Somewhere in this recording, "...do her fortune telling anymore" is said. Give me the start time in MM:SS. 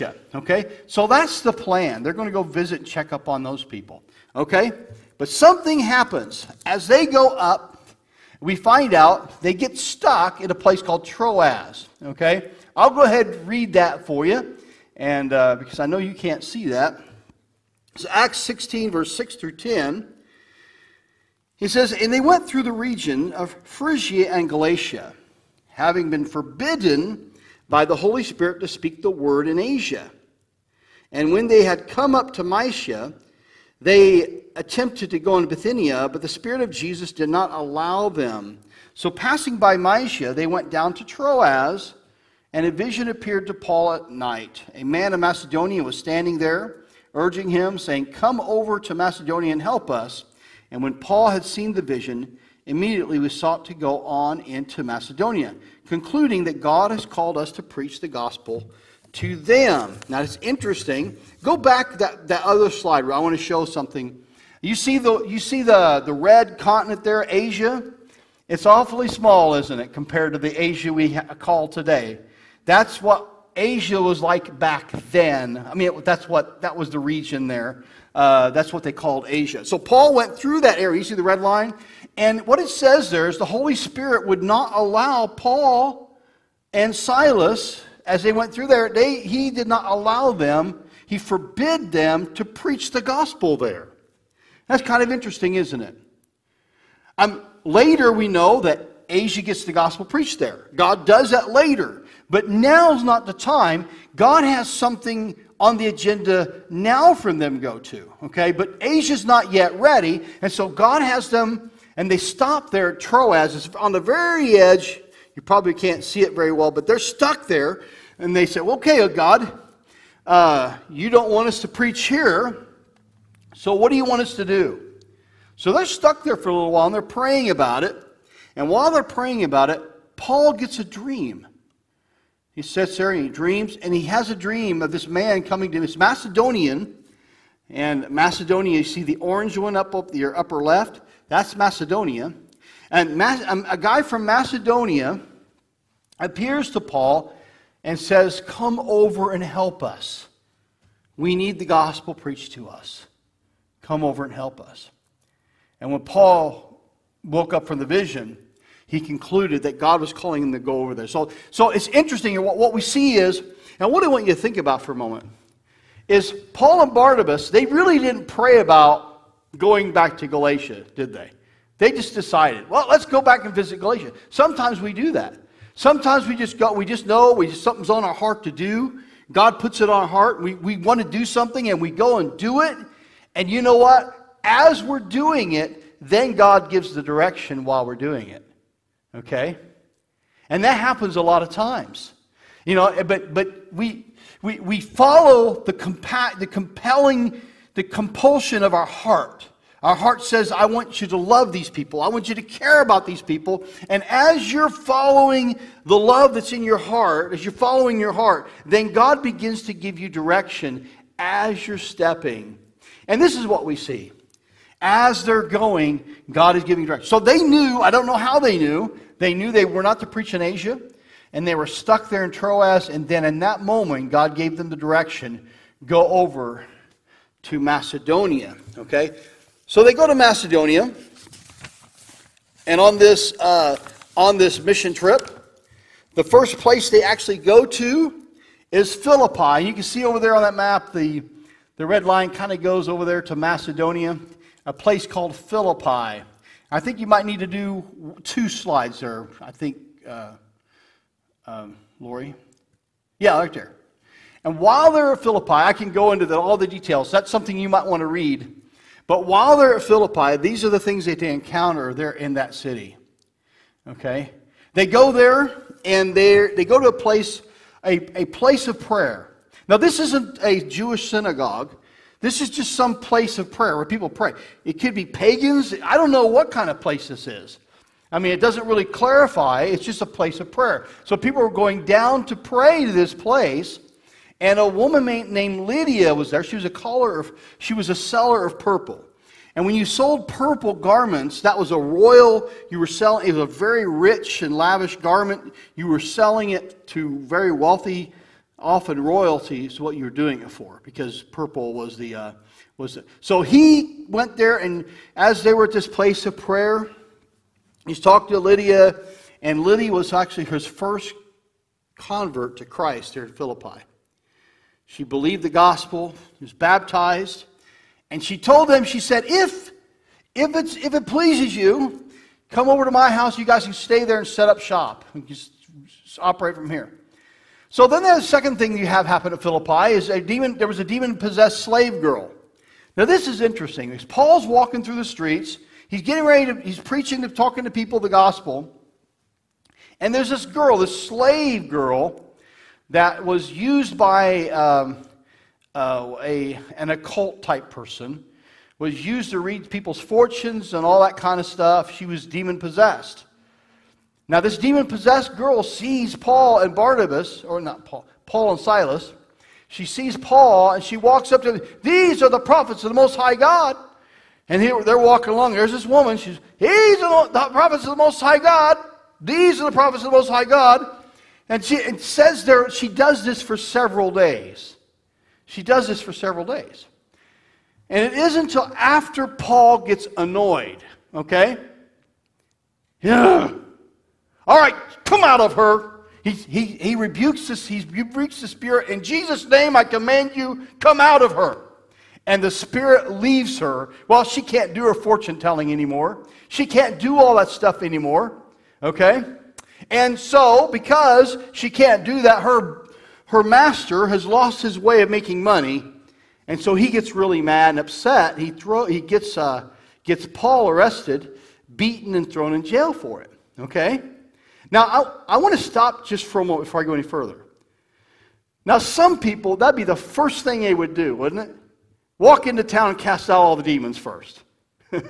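06:34.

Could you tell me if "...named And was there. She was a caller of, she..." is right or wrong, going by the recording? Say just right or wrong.
wrong.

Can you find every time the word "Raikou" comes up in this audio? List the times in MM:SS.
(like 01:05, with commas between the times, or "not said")
not said.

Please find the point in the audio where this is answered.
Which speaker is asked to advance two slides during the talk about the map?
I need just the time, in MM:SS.
04:11.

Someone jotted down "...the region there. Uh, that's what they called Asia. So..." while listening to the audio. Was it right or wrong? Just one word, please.
right.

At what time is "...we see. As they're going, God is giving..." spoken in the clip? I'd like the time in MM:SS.
03:33.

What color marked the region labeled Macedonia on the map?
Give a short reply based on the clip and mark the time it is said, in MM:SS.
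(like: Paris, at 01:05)
orange, at 02:19.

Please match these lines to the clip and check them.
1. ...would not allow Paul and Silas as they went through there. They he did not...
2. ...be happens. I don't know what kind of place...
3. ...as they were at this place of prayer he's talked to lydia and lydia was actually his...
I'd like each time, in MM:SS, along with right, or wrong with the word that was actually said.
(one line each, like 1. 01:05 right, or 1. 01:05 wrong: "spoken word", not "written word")
1. 01:24 right
2. 04:34 wrong: "pagans", not "happens"
3. 05:05 right.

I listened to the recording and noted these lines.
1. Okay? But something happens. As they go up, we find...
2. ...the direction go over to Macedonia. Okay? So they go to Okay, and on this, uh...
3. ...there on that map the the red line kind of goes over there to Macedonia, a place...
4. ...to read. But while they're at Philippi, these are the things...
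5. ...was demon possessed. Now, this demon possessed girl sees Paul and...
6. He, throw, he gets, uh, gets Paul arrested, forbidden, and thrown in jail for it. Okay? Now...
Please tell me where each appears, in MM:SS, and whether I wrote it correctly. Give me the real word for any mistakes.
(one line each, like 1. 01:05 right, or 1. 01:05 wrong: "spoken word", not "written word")
1. 00:04 right
2. 03:44 wrong: "Macedonia", not "Okay"
3. 04:00 right
4. 04:18 right
5. 05:52 right
6. 06:48 wrong: "beaten", not "forbidden".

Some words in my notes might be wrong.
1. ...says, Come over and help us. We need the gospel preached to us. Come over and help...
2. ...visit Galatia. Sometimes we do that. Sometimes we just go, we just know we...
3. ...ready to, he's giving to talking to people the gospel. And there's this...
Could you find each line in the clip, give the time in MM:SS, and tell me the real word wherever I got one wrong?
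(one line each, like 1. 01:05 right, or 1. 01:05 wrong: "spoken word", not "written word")
1. 02:27 right
2. 02:53 right
3. 05:36 wrong: "preaching", not "giving".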